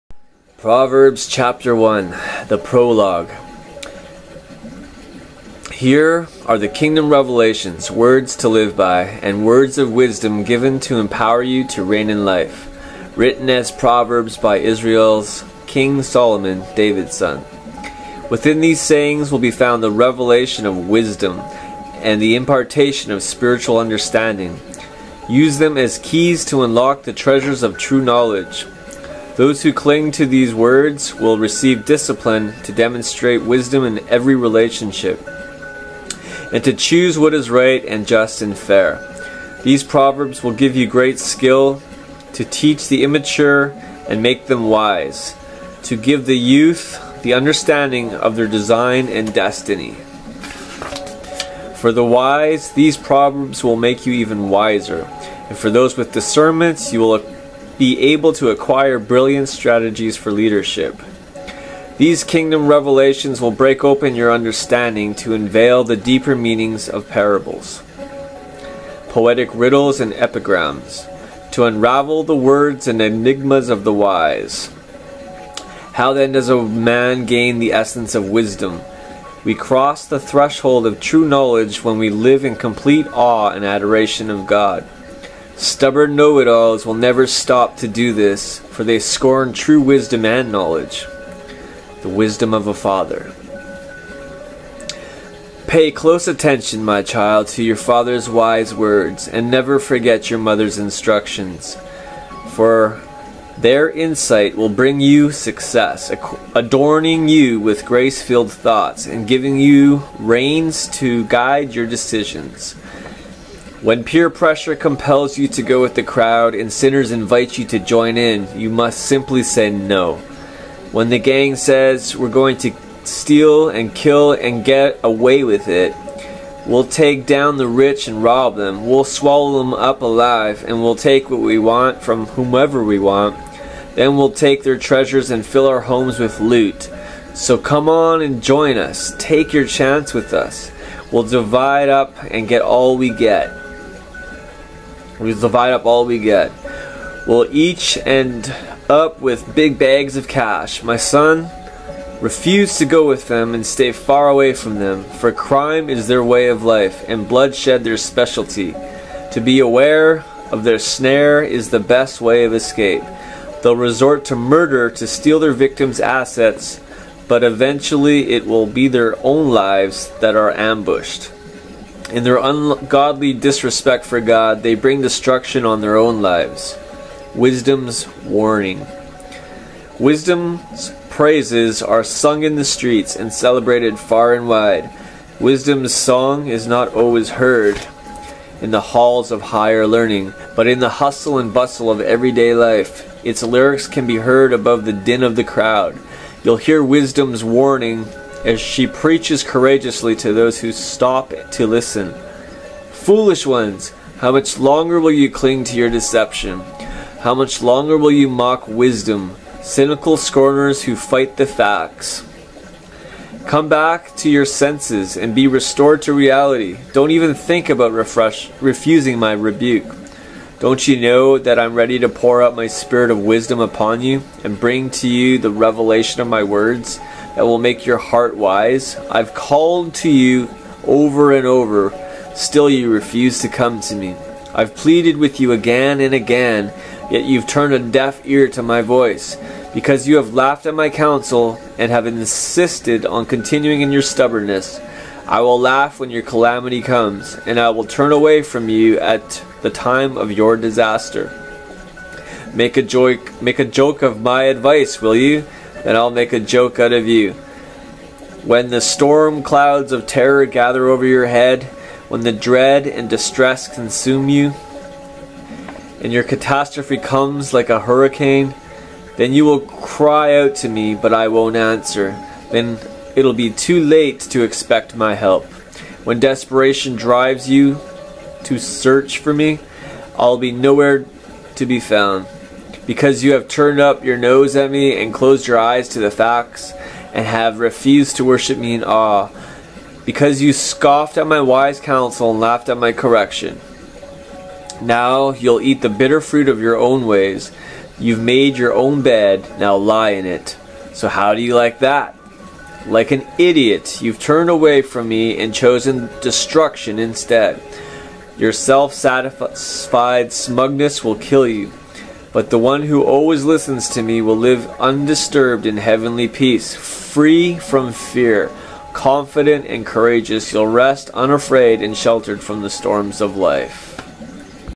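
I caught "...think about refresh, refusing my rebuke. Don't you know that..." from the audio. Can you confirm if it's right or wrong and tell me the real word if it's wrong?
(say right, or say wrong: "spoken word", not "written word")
right.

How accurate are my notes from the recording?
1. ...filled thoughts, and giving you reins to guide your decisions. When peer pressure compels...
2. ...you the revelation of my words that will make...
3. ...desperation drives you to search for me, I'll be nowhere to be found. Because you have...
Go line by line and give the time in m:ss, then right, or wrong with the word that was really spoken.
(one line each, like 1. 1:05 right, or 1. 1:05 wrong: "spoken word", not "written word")
1. 1:48 right
2. 3:45 right
3. 4:36 right.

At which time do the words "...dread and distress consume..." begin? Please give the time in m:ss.
4:22.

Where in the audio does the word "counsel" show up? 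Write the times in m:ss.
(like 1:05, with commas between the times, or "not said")
4:00, 4:51.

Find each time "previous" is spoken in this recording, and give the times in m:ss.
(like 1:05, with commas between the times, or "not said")
not said.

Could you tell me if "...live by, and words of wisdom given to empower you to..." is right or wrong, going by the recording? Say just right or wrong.
right.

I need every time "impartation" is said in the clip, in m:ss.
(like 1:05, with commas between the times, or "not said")
0:22.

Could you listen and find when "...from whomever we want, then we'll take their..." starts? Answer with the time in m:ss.
2:12.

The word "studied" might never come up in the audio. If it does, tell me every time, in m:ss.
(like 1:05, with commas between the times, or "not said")
not said.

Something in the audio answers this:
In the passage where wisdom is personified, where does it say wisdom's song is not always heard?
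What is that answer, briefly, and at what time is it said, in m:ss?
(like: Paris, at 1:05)
Halls of higher learning, at 3:08.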